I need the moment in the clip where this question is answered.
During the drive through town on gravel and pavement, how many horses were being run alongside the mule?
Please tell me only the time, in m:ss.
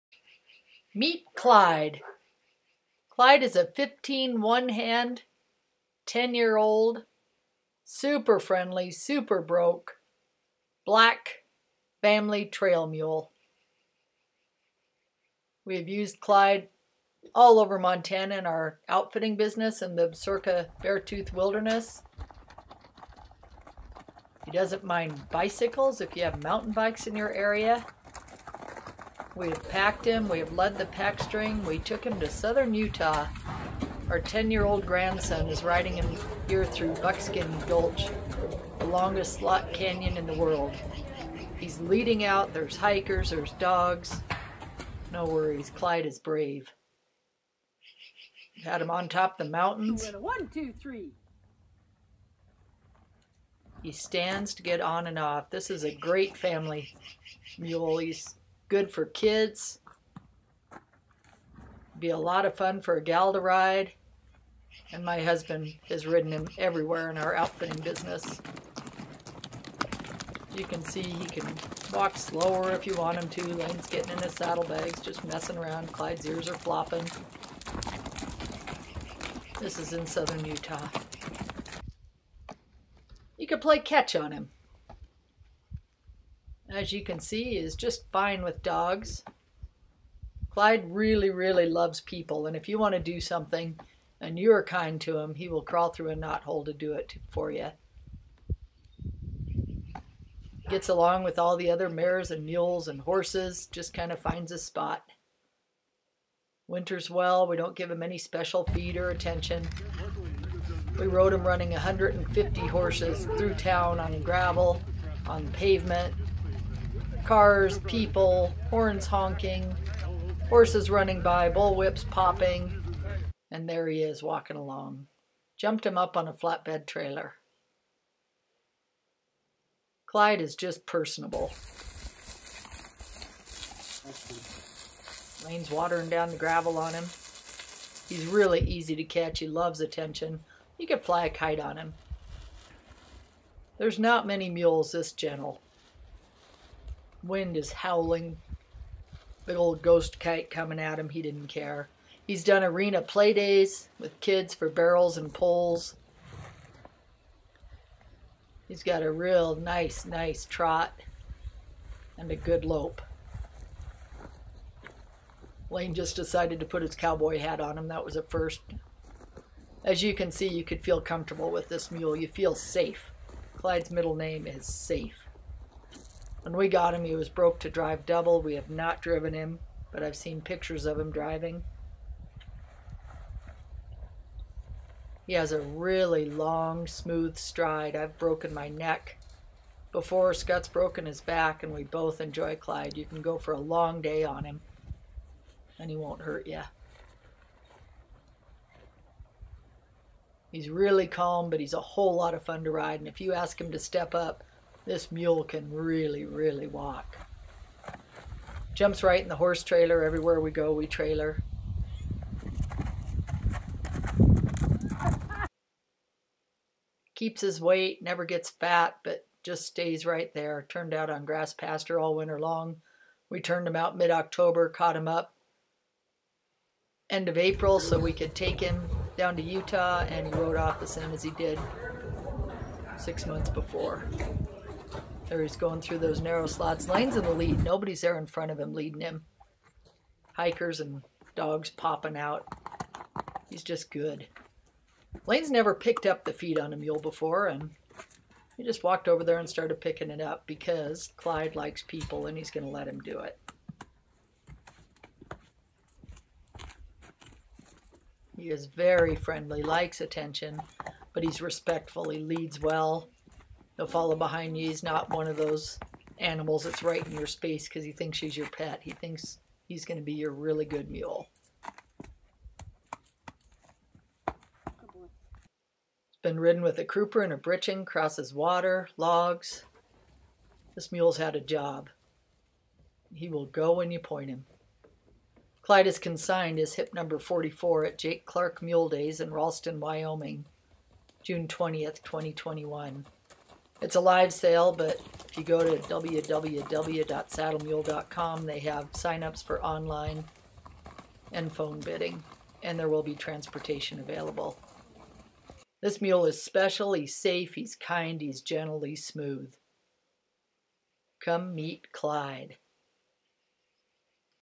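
1:51.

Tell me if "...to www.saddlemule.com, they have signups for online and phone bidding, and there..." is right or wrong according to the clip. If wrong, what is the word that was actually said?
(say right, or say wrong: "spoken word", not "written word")
right.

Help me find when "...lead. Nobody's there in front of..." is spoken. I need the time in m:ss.
3:57.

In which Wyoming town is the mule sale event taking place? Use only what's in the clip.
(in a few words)
Ralston.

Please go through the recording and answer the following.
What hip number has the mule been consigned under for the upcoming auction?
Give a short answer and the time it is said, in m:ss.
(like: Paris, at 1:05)
44, at 4:46.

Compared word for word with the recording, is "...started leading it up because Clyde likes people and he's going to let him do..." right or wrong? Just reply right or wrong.
wrong.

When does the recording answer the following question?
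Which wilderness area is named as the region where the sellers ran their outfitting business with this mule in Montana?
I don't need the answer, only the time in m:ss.
0:20.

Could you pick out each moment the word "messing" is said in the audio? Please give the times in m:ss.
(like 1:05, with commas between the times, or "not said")
1:15.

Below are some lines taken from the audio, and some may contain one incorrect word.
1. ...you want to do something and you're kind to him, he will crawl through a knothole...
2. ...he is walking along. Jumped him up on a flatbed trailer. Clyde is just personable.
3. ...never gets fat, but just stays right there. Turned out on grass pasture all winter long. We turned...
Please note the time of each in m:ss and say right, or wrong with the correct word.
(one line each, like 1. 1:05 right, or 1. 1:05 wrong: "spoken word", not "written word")
1. 1:32 right
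2. 2:03 right
3. 3:38 right.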